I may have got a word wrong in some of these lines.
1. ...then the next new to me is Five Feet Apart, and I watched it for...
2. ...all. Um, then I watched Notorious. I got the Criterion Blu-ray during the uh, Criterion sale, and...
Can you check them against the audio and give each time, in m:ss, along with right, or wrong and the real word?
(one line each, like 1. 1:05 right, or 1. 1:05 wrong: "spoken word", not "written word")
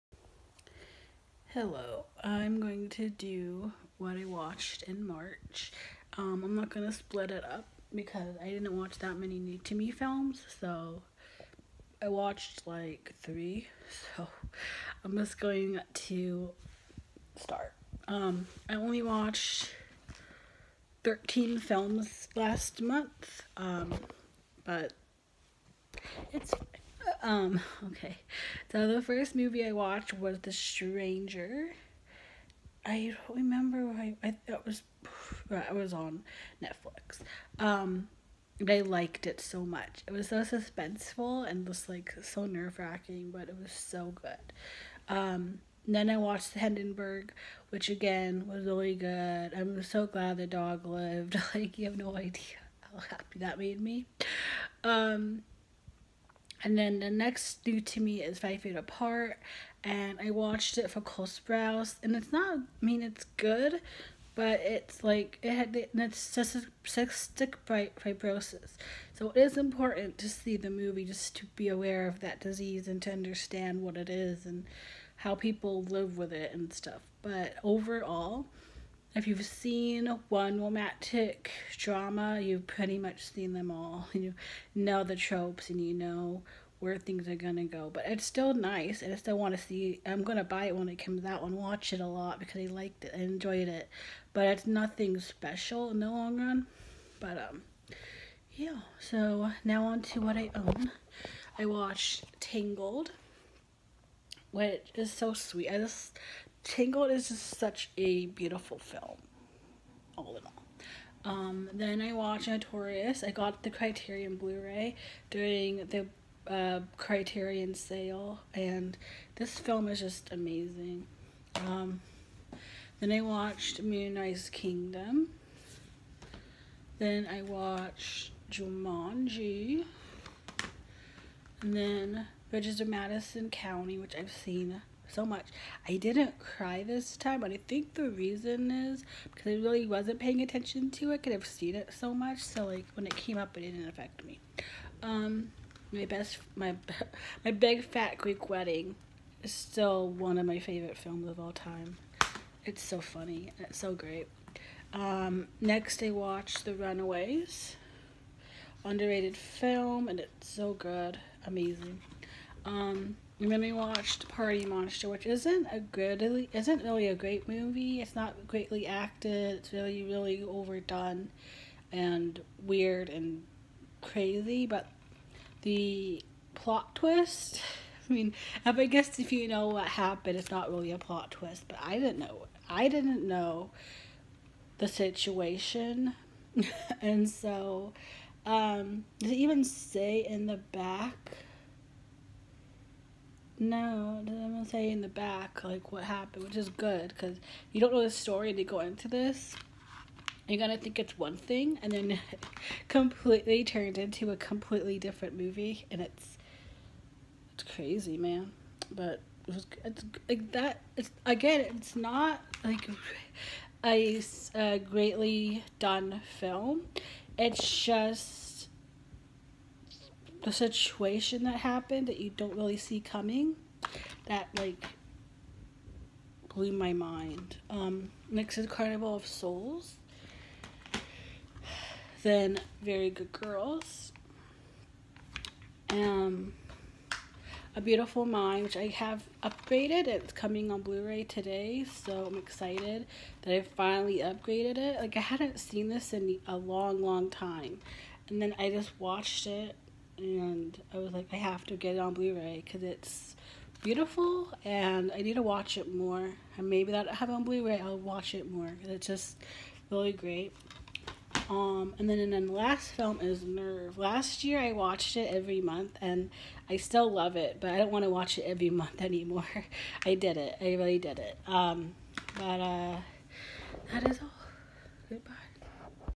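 1. 0:56 right
2. 1:50 right.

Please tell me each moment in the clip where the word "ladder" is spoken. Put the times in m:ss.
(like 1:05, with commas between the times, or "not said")
not said.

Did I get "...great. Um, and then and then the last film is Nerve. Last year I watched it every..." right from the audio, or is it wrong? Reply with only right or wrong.
right.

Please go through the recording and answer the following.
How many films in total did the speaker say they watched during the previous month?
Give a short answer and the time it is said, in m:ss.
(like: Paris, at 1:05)
13, at 0:21.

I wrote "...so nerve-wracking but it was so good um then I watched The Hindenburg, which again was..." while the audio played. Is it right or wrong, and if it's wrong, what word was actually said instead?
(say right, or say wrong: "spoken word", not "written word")
right.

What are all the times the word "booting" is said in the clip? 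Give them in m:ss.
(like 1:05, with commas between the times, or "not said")
not said.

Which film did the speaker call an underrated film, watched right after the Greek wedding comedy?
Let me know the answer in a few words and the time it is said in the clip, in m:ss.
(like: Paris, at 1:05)
The Runaways, at 2:36.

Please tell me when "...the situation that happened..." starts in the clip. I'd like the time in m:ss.
3:40.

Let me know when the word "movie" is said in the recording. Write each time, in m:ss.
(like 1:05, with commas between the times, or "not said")
0:29, 1:10, 2:47, 3:25.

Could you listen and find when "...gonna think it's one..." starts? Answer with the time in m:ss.
3:20.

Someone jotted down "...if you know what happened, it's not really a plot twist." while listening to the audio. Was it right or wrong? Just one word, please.
right.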